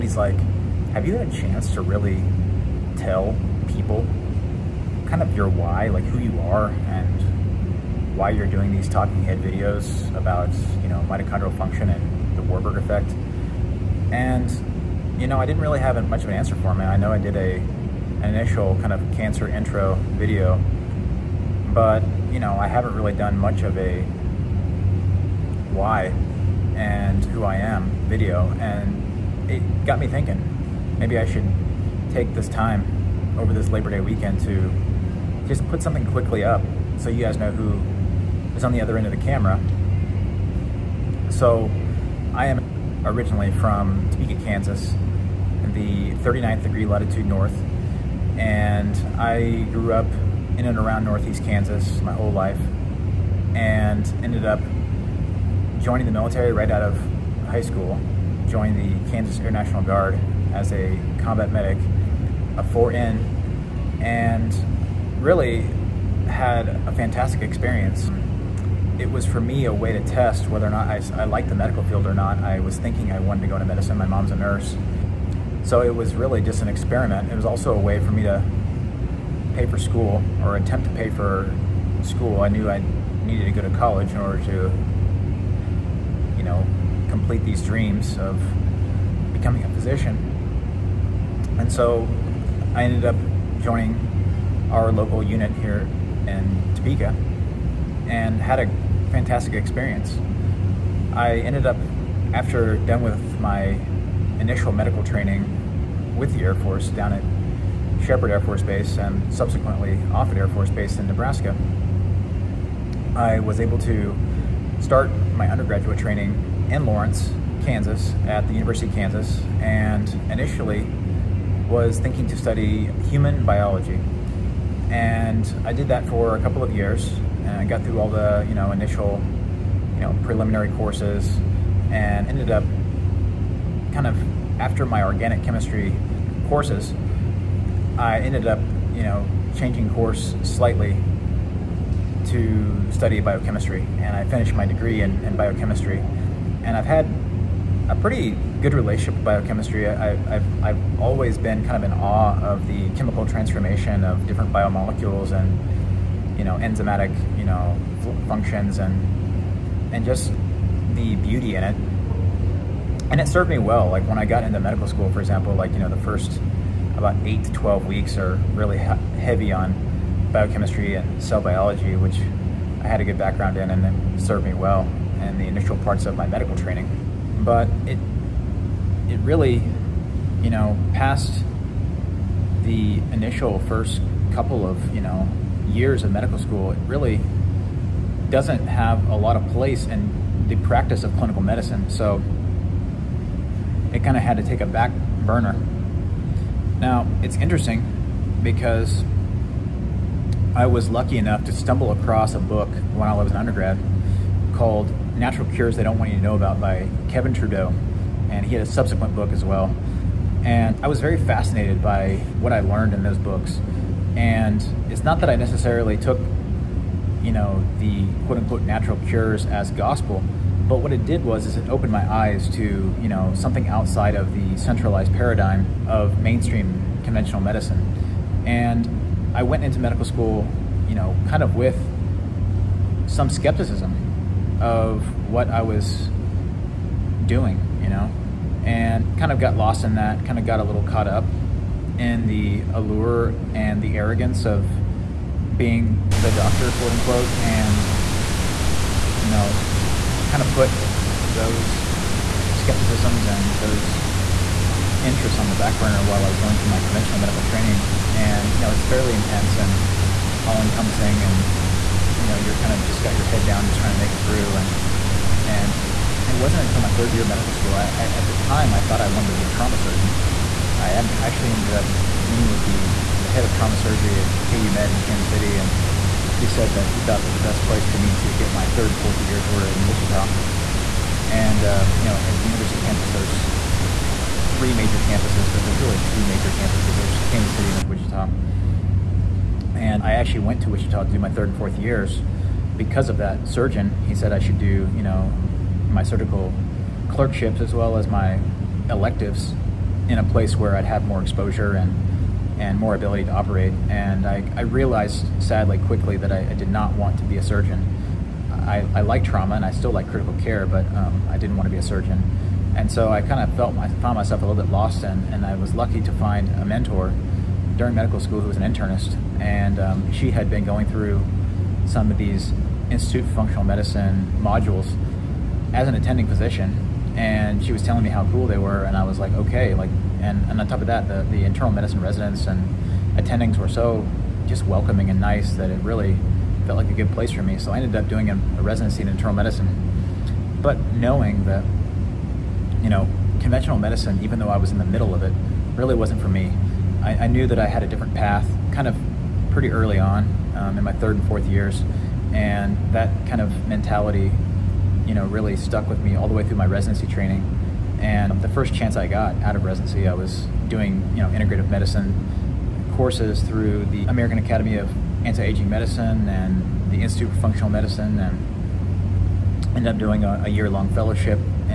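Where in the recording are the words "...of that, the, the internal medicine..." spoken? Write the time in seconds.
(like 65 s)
330 s.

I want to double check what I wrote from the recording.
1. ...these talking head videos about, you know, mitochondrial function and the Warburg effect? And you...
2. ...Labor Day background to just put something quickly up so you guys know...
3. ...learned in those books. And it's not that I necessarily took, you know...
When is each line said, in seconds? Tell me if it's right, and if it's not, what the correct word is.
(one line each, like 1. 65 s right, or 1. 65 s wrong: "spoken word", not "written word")
1. 8 s right
2. 33 s wrong: "weekend", not "background"
3. 212 s right.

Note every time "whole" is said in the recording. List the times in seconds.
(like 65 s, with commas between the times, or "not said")
52 s.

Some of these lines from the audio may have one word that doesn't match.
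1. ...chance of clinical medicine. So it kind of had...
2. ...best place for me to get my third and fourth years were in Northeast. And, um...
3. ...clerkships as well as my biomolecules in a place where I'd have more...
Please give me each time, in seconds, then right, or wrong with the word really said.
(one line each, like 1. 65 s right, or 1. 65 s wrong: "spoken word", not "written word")
1. 190 s wrong: "practice", not "chance"
2. 277 s wrong: "Wichita", not "Northeast"
3. 297 s wrong: "electives", not "biomolecules".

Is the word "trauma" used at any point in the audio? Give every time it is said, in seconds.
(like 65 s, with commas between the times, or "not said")
269 s, 273 s, 309 s.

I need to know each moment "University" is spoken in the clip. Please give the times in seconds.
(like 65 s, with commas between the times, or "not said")
118 s, 282 s.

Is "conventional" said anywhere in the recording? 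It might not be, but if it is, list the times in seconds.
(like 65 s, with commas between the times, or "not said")
227 s, 256 s, 343 s.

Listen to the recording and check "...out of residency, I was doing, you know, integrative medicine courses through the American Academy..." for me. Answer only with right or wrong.
right.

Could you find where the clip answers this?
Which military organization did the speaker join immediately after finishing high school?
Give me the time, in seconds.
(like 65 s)
59 s.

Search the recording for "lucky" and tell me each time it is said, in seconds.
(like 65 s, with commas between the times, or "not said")
200 s, 315 s.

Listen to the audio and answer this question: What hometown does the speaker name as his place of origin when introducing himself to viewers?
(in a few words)
Topeka, Kansas.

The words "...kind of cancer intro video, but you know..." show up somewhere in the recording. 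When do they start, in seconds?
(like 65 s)
18 s.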